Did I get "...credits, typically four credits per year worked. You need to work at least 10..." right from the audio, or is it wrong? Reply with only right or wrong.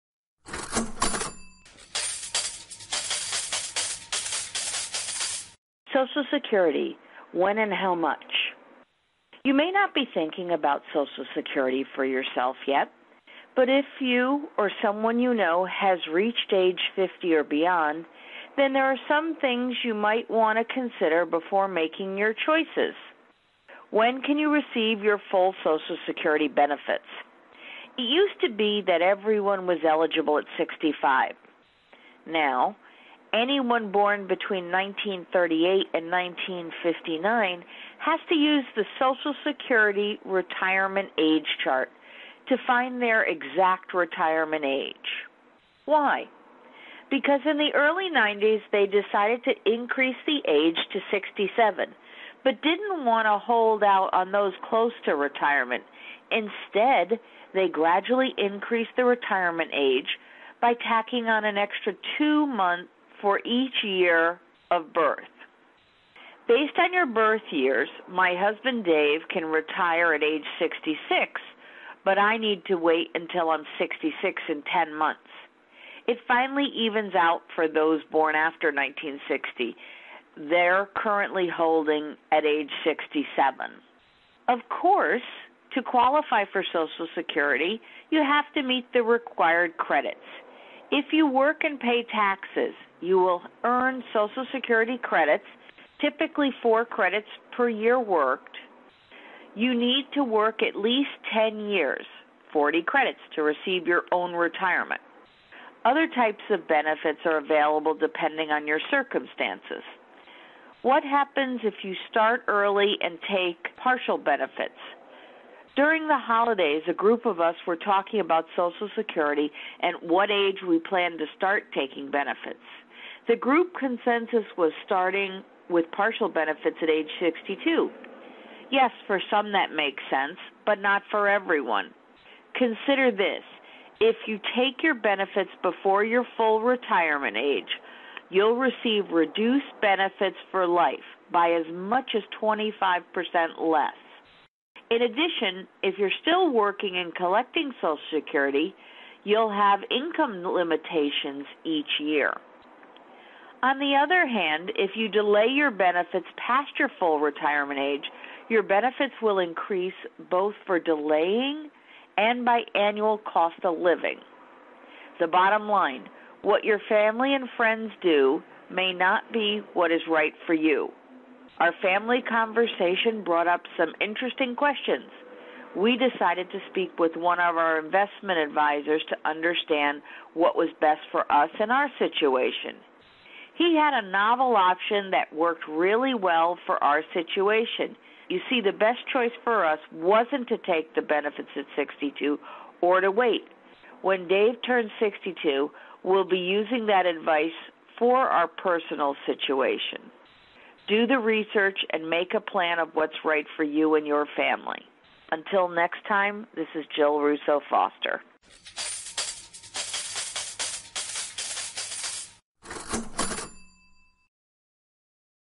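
right.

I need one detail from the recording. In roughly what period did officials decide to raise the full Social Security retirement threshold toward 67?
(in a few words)
early 90s.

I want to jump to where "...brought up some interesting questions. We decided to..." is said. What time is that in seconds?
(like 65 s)
173 s.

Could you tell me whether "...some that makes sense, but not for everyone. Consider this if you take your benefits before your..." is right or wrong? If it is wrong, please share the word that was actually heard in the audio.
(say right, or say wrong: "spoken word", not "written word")
right.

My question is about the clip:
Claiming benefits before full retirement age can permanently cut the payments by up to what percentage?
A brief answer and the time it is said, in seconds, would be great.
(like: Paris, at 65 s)
25%, at 142 s.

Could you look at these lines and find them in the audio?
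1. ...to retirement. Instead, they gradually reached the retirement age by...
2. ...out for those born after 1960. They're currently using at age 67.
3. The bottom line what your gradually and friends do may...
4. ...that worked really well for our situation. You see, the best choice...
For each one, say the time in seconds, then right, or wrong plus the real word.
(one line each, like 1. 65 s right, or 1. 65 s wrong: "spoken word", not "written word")
1. 55 s wrong: "increased", not "reached"
2. 77 s wrong: "holding", not "using"
3. 165 s wrong: "family", not "gradually"
4. 185 s right.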